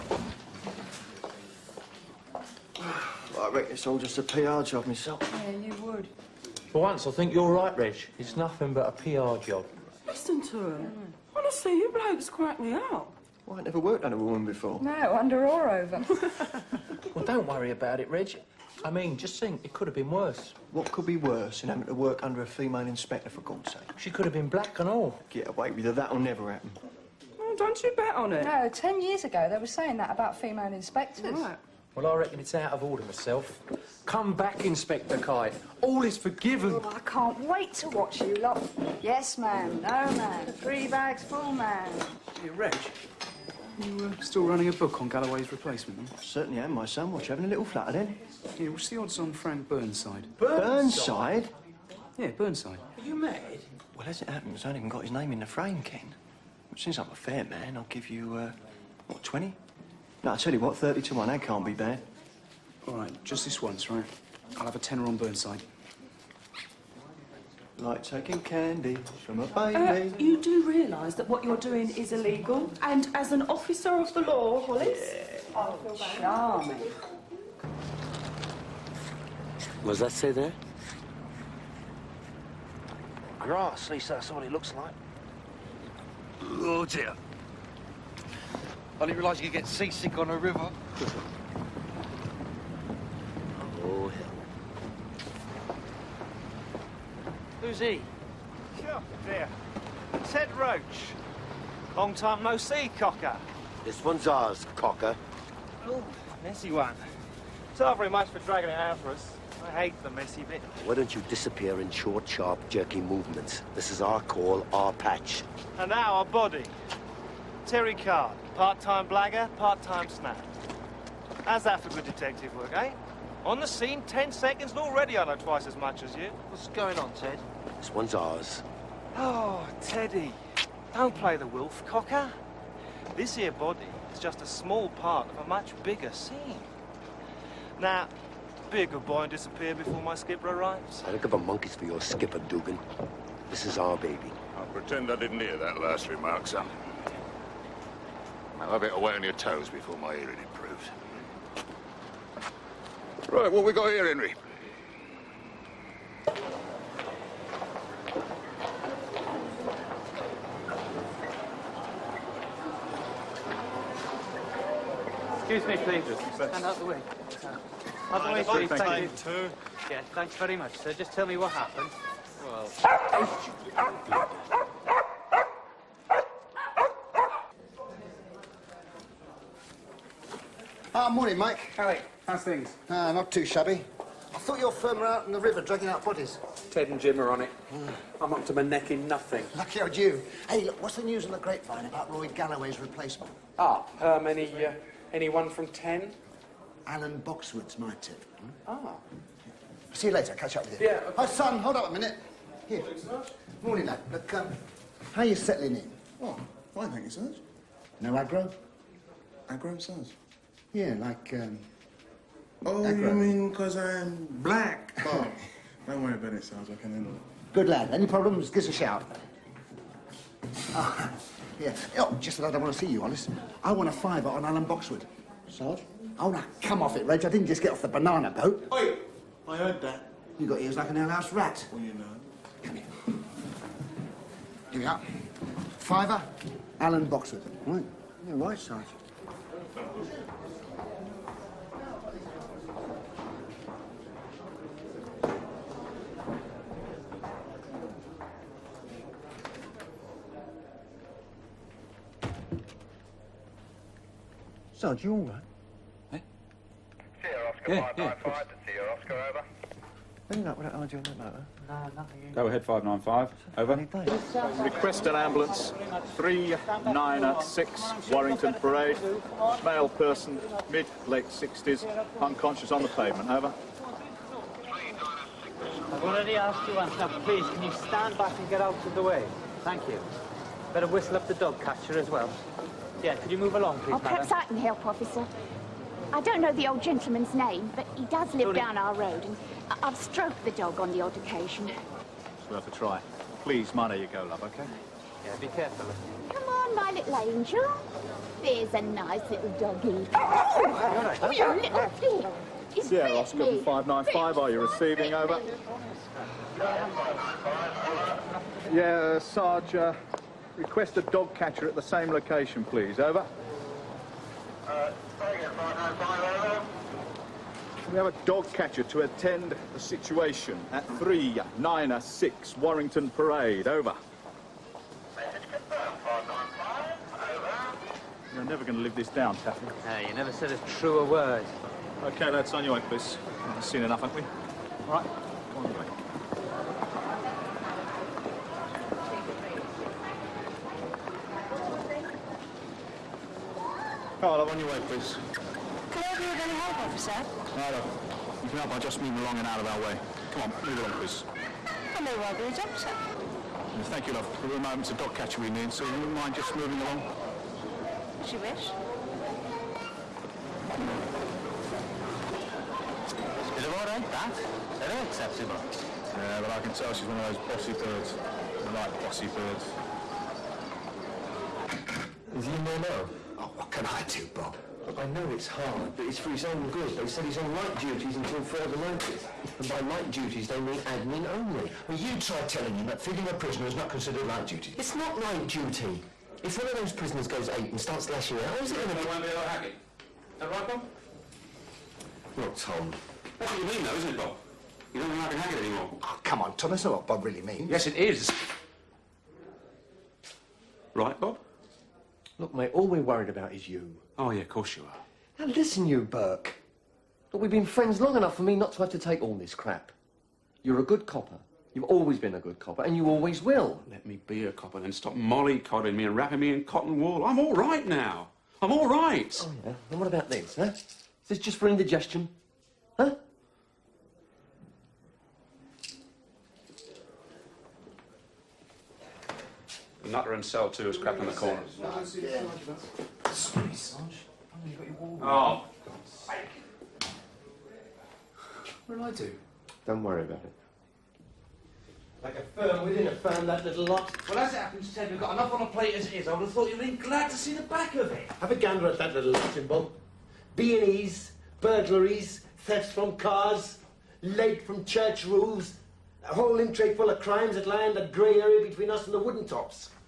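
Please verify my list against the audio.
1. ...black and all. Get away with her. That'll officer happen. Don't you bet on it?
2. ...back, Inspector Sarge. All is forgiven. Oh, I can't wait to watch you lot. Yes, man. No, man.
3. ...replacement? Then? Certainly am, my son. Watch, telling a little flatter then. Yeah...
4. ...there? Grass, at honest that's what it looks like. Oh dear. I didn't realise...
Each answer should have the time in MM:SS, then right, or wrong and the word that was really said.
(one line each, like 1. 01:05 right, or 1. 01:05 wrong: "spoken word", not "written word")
1. 00:24 wrong: "never", not "officer"
2. 00:34 wrong: "Kite", not "Sarge"
3. 00:45 wrong: "having", not "telling"
4. 01:20 wrong: "least", not "honest".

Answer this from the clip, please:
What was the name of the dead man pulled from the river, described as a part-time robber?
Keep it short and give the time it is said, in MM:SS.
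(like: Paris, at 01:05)
Terry Card, at 01:57.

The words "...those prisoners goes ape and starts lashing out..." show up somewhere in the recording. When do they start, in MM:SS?
06:26.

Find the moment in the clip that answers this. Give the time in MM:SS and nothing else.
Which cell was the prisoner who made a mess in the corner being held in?
07:10.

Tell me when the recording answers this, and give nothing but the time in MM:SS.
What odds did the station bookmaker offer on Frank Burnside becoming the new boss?
01:00.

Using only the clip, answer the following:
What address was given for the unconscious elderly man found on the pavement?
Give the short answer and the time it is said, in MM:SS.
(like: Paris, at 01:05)
396 Warrington Parade, at 04:26.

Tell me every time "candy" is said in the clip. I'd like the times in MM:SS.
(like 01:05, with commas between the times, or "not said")
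01:08.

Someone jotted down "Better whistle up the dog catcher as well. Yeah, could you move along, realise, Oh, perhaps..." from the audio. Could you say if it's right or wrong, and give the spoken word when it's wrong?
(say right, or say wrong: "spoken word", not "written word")
wrong: "please", not "realise".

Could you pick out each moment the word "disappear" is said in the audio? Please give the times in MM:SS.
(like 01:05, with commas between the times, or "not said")
01:51, 02:19.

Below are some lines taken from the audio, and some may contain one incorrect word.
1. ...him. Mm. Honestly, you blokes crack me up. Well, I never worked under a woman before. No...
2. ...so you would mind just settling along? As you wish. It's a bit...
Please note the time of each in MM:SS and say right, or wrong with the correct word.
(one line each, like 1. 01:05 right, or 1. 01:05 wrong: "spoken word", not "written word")
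1. 00:10 right
2. 05:55 wrong: "moving", not "settling".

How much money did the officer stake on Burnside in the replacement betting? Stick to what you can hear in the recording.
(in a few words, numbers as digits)
a tenner.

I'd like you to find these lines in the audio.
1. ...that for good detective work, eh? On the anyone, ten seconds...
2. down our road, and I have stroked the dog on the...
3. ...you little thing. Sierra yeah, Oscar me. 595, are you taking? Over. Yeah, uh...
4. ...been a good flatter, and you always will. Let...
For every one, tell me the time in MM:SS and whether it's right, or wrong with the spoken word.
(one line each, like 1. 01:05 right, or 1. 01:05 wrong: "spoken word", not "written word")
1. 02:01 wrong: "scene", not "anyone"
2. 04:48 right
3. 05:01 wrong: "receiving", not "taking"
4. 06:52 wrong: "copper", not "flatter".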